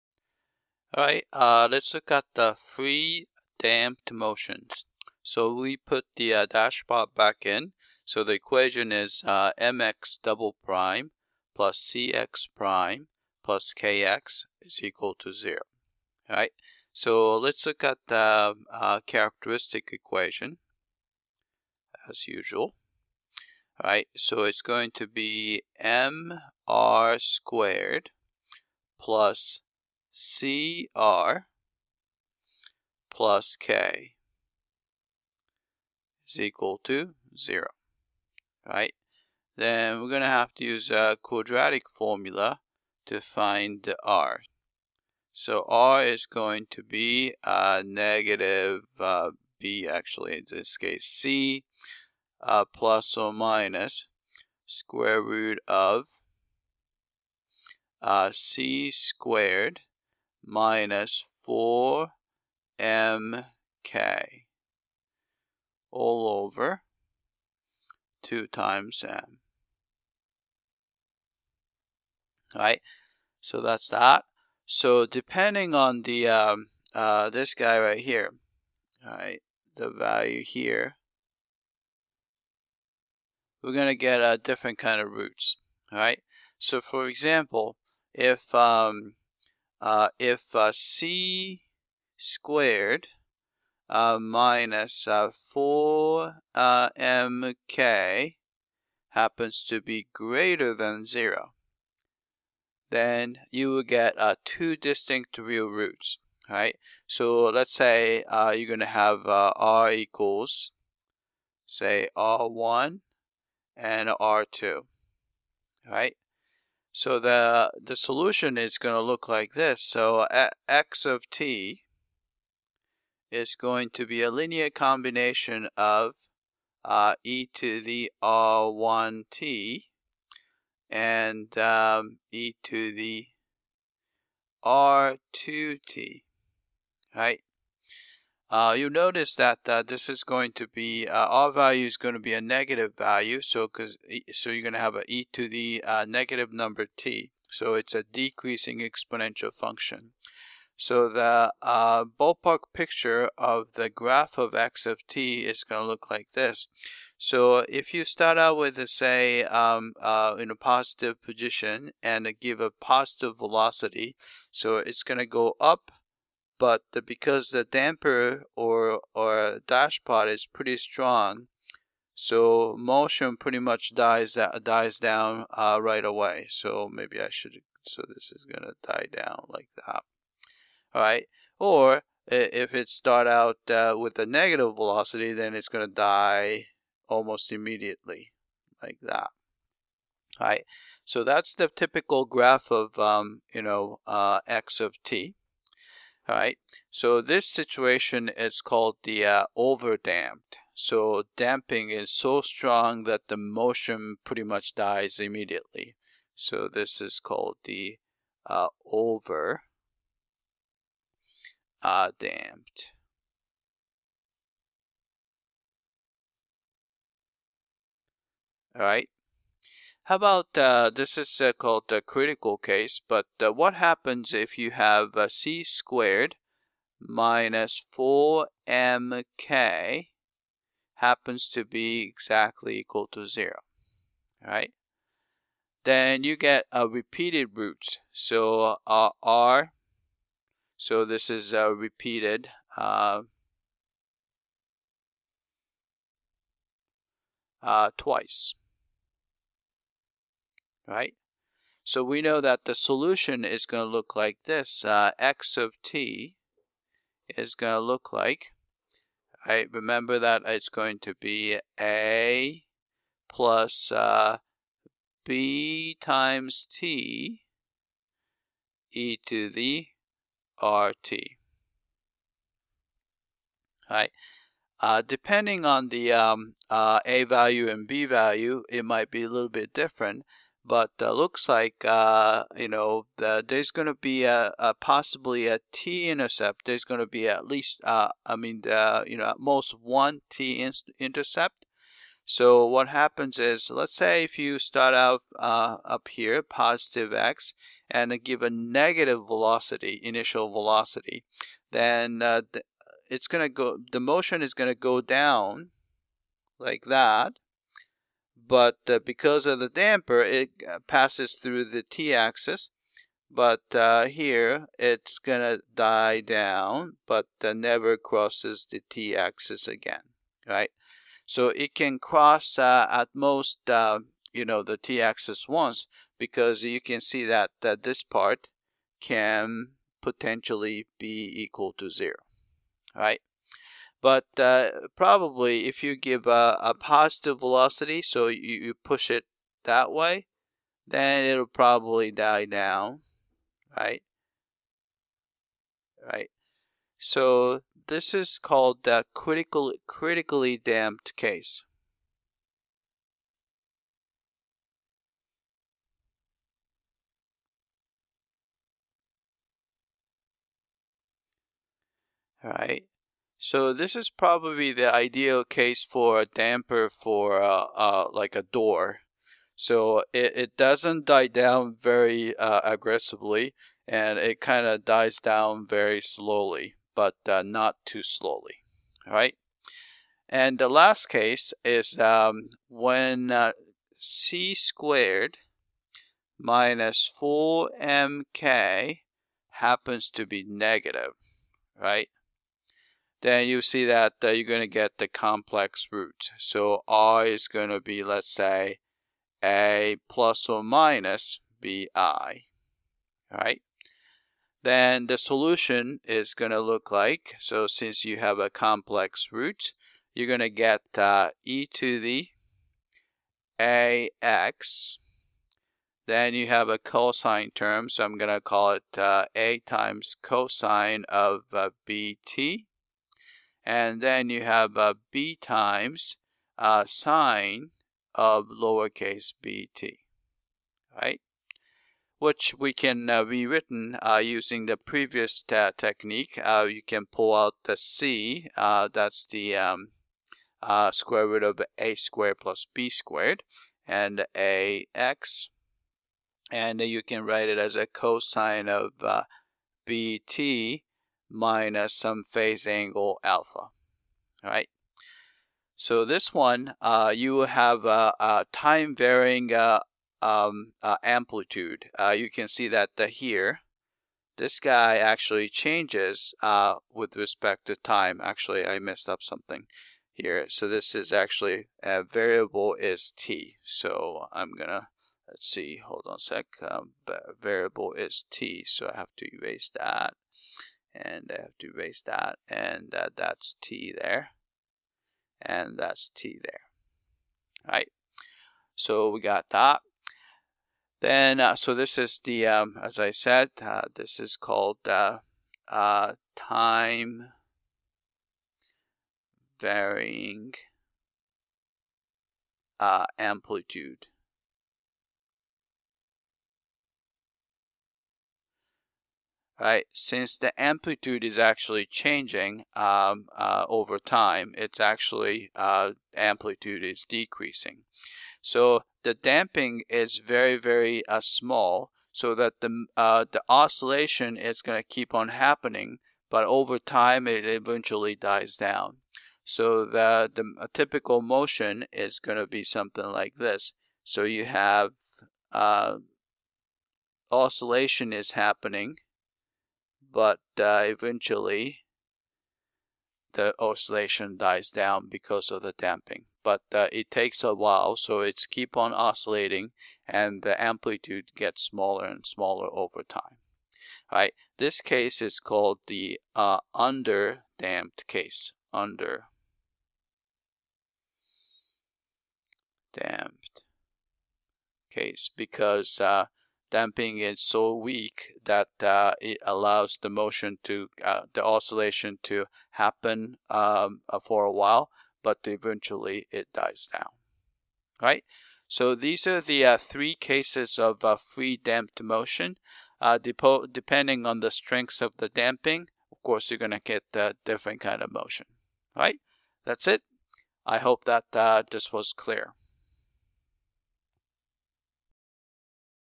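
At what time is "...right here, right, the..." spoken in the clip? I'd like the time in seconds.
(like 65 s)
77 s.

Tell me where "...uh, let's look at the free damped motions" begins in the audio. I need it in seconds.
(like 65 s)
1 s.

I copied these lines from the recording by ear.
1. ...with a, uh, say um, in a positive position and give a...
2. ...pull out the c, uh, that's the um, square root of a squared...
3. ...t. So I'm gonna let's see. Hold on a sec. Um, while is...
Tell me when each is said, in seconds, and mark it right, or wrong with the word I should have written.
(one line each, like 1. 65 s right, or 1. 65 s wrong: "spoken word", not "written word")
1. 158 s right
2. 437 s right
3. 473 s wrong: "variable", not "while".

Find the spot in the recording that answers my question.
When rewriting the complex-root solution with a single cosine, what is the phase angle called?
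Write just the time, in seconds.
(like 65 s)
453 s.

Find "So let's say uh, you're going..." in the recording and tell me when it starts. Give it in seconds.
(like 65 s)
107 s.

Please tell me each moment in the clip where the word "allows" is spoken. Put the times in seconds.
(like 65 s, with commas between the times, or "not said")
569 s.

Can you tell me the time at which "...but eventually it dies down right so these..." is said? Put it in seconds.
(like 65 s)
575 s.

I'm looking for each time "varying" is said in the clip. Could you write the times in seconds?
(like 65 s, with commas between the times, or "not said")
458 s, 499 s.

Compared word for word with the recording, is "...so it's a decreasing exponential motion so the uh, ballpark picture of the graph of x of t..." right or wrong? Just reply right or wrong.
wrong.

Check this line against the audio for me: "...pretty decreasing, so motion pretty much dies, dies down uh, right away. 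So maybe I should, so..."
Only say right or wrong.
wrong.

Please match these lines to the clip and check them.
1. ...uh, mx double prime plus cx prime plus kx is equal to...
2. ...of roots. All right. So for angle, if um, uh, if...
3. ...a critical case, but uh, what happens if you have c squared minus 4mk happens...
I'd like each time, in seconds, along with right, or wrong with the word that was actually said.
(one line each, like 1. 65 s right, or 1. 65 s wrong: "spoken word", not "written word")
1. 9 s right
2. 85 s wrong: "example", not "angle"
3. 221 s right.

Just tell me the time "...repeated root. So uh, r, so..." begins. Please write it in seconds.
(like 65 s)
236 s.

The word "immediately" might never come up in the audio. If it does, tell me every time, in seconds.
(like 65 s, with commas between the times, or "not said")
187 s, 205 s.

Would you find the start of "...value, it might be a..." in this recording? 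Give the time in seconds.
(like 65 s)
278 s.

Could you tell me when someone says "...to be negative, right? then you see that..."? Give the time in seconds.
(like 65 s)
390 s.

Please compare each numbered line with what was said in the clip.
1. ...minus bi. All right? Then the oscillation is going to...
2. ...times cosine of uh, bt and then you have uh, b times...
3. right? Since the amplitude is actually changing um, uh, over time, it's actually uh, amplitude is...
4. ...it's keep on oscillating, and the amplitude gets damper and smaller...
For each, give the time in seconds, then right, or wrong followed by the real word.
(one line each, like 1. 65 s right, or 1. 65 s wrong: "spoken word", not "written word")
1. 400 s wrong: "solution", not "oscillation"
2. 419 s right
3. 509 s right
4. 548 s wrong: "smaller", not "damper".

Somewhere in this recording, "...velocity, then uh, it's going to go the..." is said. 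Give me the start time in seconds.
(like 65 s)
300 s.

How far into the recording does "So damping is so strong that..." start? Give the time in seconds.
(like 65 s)
200 s.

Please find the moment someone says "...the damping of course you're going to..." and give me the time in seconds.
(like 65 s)
585 s.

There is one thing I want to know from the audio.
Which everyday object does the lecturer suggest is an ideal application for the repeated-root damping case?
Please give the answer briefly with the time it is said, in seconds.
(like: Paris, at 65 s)
a door, at 368 s.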